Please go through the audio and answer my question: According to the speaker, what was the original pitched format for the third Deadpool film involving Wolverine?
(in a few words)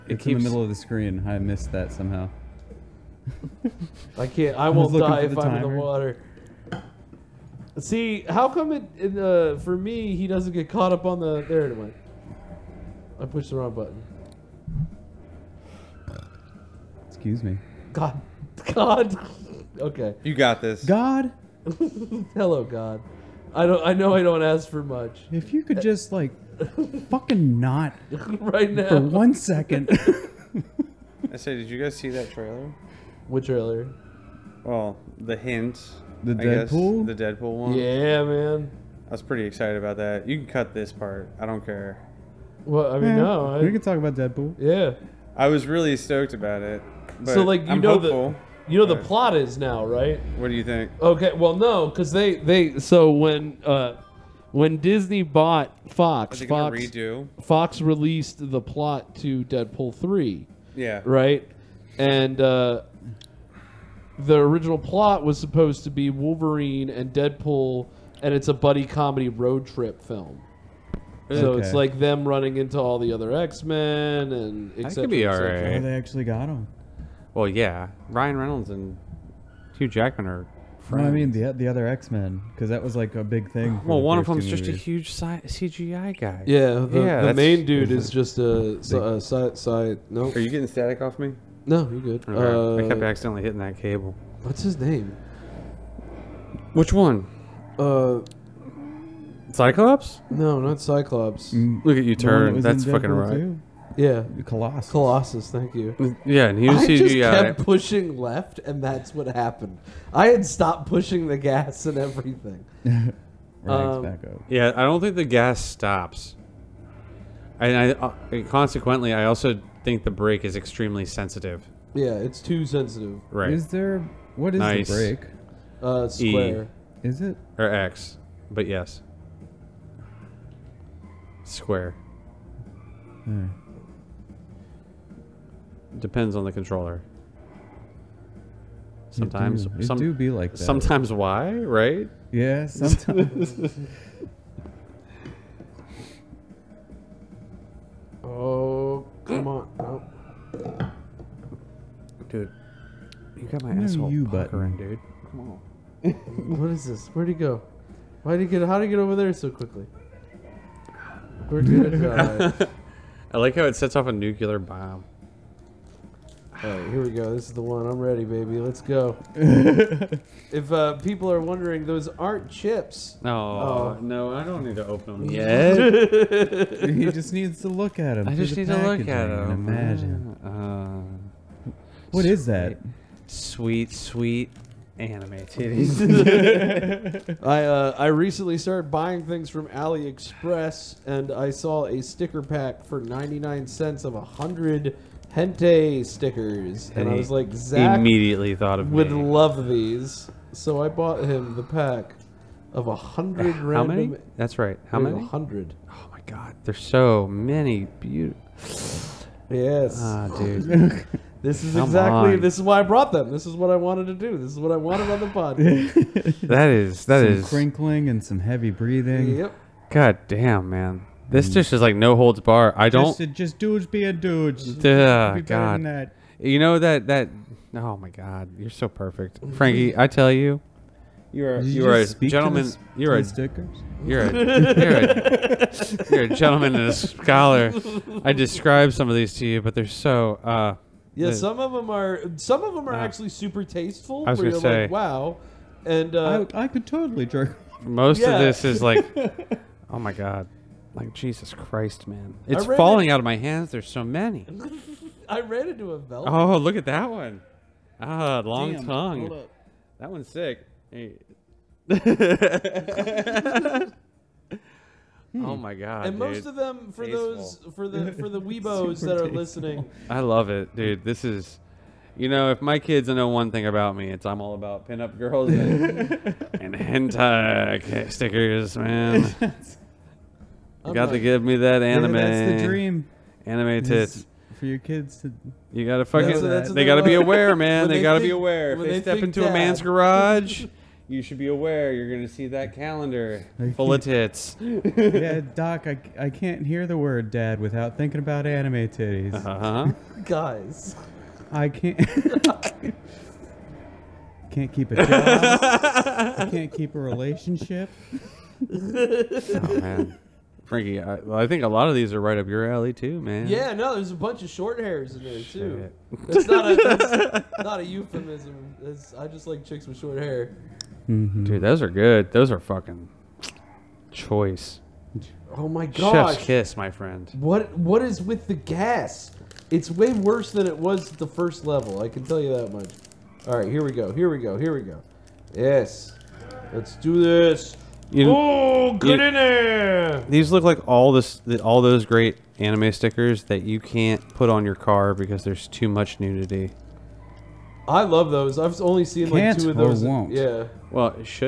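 Buddy comedy road trip film.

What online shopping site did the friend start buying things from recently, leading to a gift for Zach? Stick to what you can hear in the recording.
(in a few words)
AliExpress.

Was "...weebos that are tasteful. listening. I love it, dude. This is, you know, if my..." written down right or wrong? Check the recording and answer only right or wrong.
right.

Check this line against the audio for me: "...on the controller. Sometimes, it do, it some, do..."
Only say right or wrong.
right.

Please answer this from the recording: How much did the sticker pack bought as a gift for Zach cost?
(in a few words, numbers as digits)
99 cents.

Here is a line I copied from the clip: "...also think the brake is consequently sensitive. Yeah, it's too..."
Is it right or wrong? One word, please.
wrong.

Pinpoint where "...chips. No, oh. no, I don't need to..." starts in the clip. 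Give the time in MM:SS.
02:52.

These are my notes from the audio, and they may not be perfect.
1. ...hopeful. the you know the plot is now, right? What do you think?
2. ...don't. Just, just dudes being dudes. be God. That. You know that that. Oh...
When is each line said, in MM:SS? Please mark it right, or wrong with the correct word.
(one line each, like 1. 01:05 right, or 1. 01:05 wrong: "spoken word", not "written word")
1. 00:47 right
2. 03:42 right.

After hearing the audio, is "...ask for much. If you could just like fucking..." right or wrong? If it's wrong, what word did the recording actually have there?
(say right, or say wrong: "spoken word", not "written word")
right.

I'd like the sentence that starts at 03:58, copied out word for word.
I described some of these to you, but they're so.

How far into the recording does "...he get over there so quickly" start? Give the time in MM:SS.
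02:38.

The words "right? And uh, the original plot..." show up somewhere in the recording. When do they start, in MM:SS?
01:01.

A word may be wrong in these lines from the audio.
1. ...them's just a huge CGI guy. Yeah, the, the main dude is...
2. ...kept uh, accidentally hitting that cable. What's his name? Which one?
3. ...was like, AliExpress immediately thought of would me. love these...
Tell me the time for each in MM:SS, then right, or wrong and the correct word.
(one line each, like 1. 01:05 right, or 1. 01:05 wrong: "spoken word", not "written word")
1. 01:24 right
2. 01:32 right
3. 03:17 wrong: "Zach", not "AliExpress".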